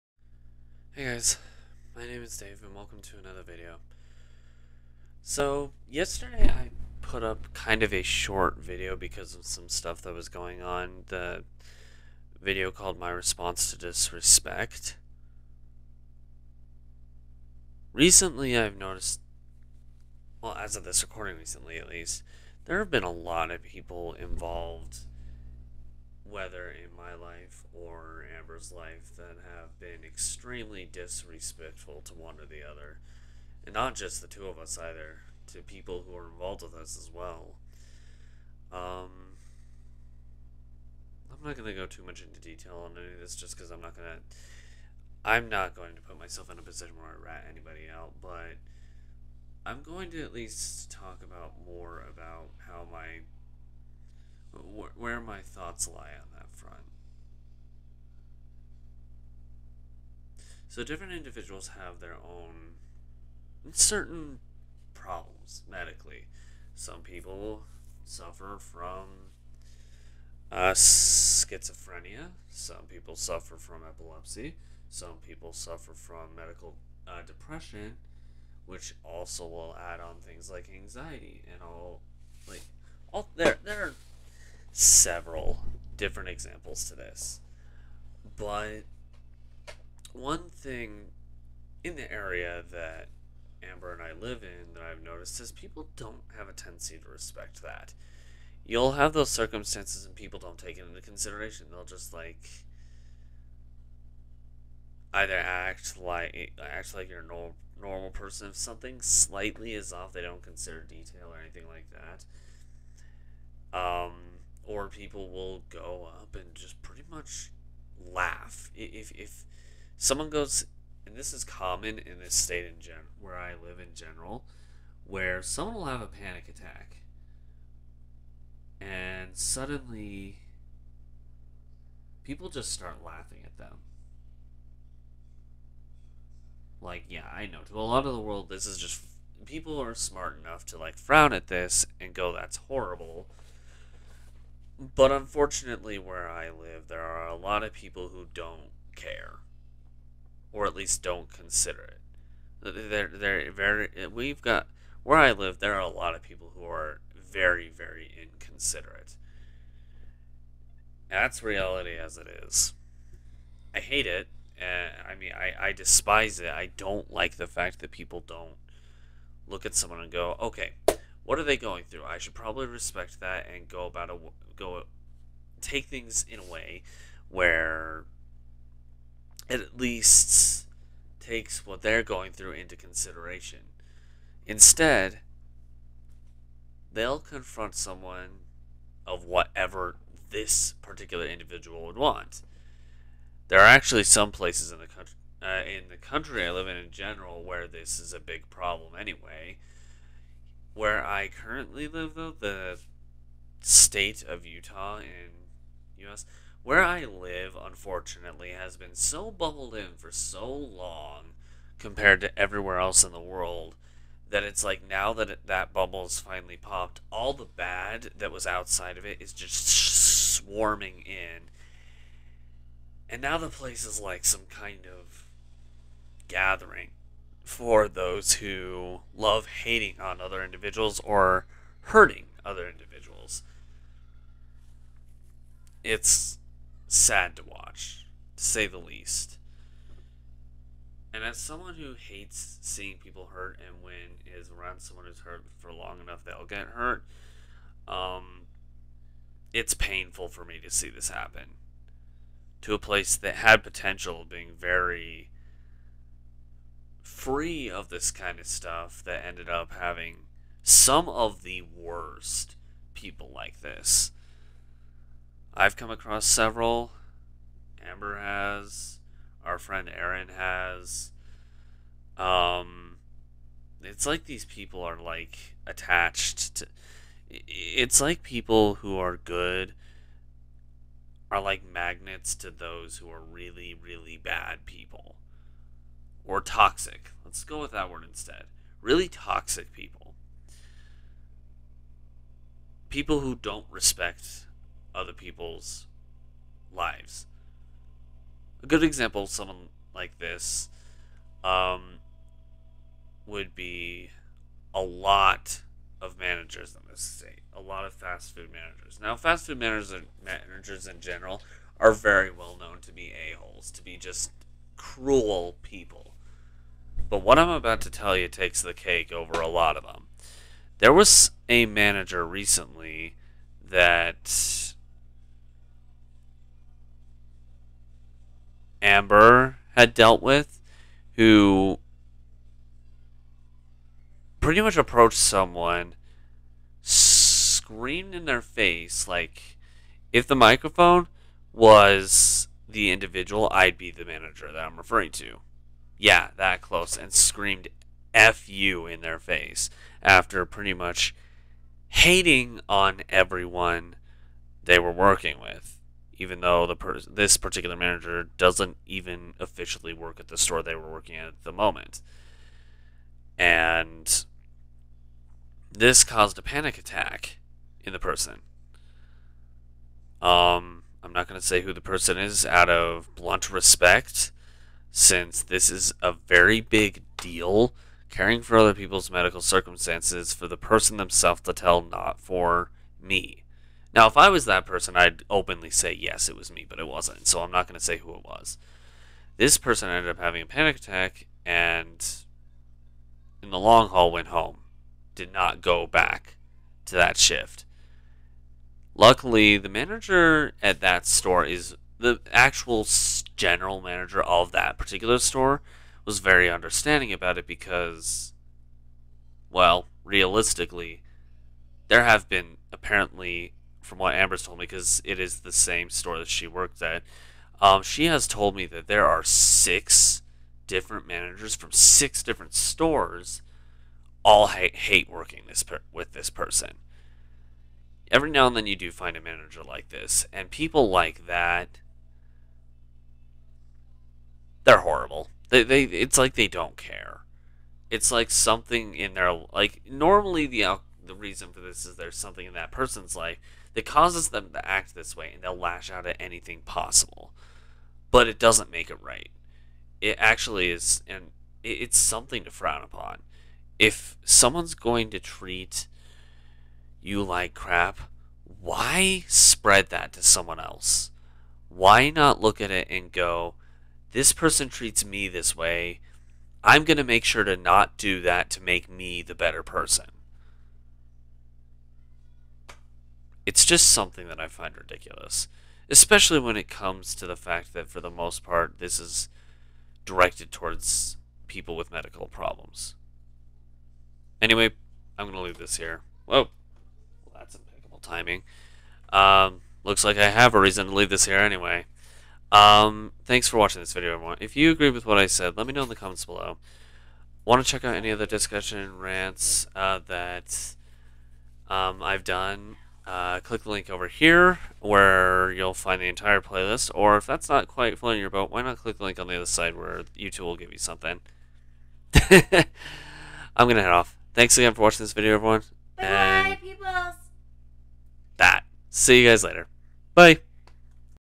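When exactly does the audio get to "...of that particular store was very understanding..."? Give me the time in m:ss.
6:44.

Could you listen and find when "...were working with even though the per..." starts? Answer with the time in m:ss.
5:54.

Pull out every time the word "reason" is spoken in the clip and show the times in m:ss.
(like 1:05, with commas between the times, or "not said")
7:21, 8:10.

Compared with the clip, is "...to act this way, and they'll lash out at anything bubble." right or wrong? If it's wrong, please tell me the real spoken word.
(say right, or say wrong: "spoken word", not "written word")
wrong: "possible", not "bubble".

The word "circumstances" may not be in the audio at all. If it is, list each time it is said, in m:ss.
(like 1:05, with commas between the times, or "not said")
1:39, 6:19.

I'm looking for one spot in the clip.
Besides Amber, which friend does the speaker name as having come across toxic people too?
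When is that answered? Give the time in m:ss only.
4:29.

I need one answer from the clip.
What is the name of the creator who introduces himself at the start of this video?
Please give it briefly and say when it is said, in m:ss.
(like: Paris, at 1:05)
Dave, at 0:02.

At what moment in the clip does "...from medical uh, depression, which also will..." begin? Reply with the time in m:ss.
1:15.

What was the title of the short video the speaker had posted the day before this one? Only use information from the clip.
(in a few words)
My Response to Disrespect.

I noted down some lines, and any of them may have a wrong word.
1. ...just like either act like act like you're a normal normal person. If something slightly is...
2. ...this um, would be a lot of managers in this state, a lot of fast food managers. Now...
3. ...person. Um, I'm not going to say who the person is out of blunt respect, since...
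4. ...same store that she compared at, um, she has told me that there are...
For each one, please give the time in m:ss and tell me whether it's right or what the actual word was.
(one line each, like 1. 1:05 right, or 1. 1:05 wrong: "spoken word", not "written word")
1. 1:41 right
2. 5:00 right
3. 6:07 right
4. 6:55 wrong: "worked", not "compared".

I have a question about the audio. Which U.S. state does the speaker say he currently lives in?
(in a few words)
Utah.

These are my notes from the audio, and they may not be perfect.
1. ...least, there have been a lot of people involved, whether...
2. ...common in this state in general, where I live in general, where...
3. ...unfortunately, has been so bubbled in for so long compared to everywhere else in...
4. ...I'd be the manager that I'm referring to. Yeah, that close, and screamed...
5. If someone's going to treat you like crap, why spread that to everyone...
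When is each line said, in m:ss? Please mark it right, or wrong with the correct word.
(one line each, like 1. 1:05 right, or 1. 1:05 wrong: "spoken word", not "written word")
1. 0:21 right
2. 2:01 right
3. 3:27 right
4. 5:43 right
5. 7:33 wrong: "someone", not "everyone".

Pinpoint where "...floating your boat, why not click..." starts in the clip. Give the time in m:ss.
8:27.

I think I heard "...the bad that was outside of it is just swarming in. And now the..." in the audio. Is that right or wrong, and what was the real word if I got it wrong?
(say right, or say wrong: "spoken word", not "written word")
right.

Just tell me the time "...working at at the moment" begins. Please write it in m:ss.
6:00.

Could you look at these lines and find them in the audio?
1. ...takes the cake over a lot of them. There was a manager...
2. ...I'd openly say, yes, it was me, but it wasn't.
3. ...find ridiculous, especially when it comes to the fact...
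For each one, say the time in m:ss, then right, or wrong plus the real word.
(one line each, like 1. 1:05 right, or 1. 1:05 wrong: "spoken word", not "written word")
1. 5:18 right
2. 6:24 right
3. 7:54 right.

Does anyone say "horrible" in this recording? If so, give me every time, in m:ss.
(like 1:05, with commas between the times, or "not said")
2:22, 7:14.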